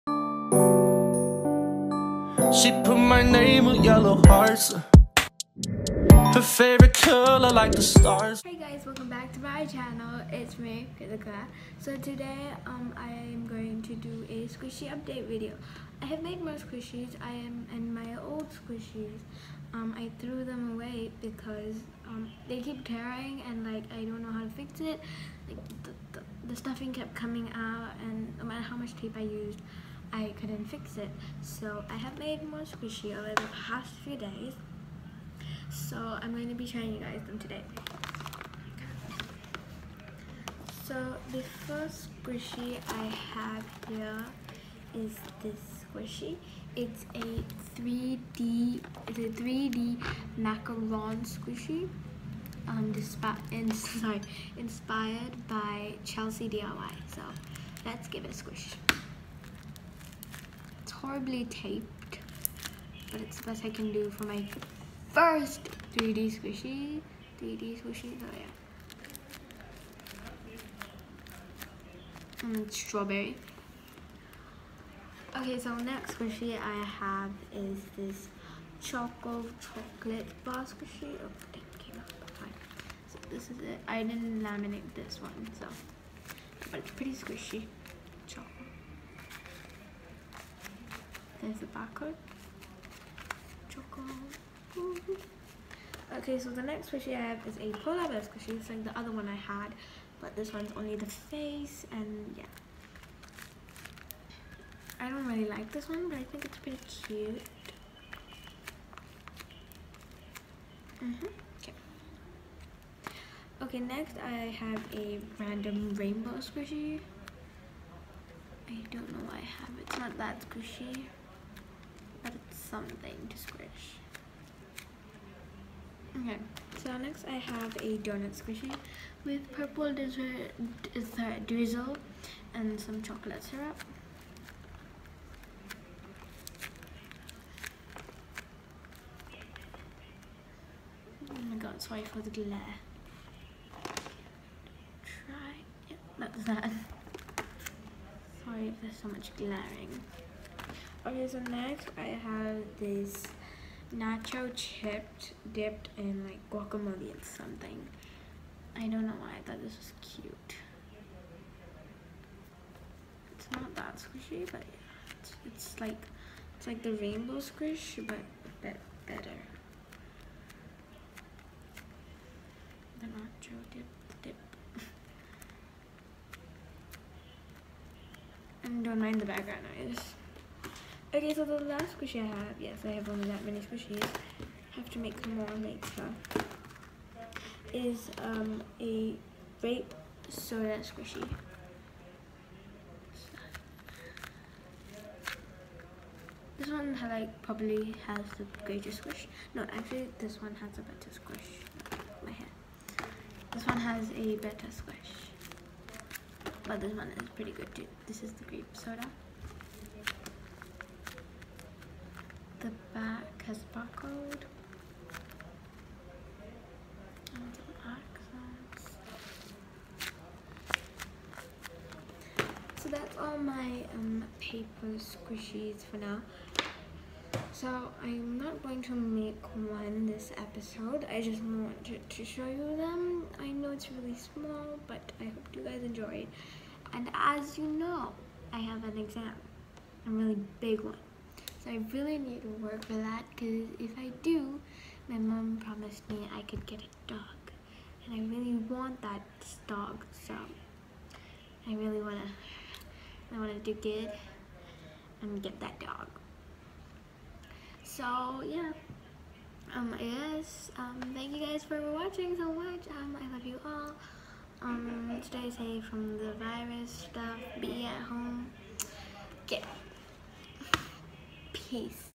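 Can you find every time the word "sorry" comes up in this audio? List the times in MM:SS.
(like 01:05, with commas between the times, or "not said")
00:53, 02:21, 02:28.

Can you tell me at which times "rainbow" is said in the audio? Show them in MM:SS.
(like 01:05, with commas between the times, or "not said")
01:55, 02:46.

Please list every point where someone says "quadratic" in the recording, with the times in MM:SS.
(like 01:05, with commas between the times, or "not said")
not said.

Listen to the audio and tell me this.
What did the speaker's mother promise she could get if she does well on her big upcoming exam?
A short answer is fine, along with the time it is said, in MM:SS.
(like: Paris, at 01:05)
A dog, at 04:06.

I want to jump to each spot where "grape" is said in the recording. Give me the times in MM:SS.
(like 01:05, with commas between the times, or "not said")
03:09, 03:28.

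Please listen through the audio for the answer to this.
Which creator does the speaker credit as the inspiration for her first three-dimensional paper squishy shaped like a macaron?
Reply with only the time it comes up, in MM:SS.
00:56.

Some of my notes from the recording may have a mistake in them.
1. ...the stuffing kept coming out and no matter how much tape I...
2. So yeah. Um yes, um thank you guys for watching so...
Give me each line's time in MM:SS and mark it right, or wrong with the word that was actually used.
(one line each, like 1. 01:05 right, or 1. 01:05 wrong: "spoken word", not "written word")
1. 00:26 right
2. 04:17 right.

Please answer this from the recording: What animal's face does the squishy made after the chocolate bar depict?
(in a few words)
Polar bear.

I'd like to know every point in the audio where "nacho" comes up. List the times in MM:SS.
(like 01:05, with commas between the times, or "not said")
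02:33, 02:53.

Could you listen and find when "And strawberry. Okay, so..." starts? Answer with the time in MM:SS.
01:12.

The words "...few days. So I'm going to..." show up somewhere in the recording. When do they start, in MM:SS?
00:34.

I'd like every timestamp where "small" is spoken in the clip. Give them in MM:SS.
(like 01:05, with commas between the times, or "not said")
03:54.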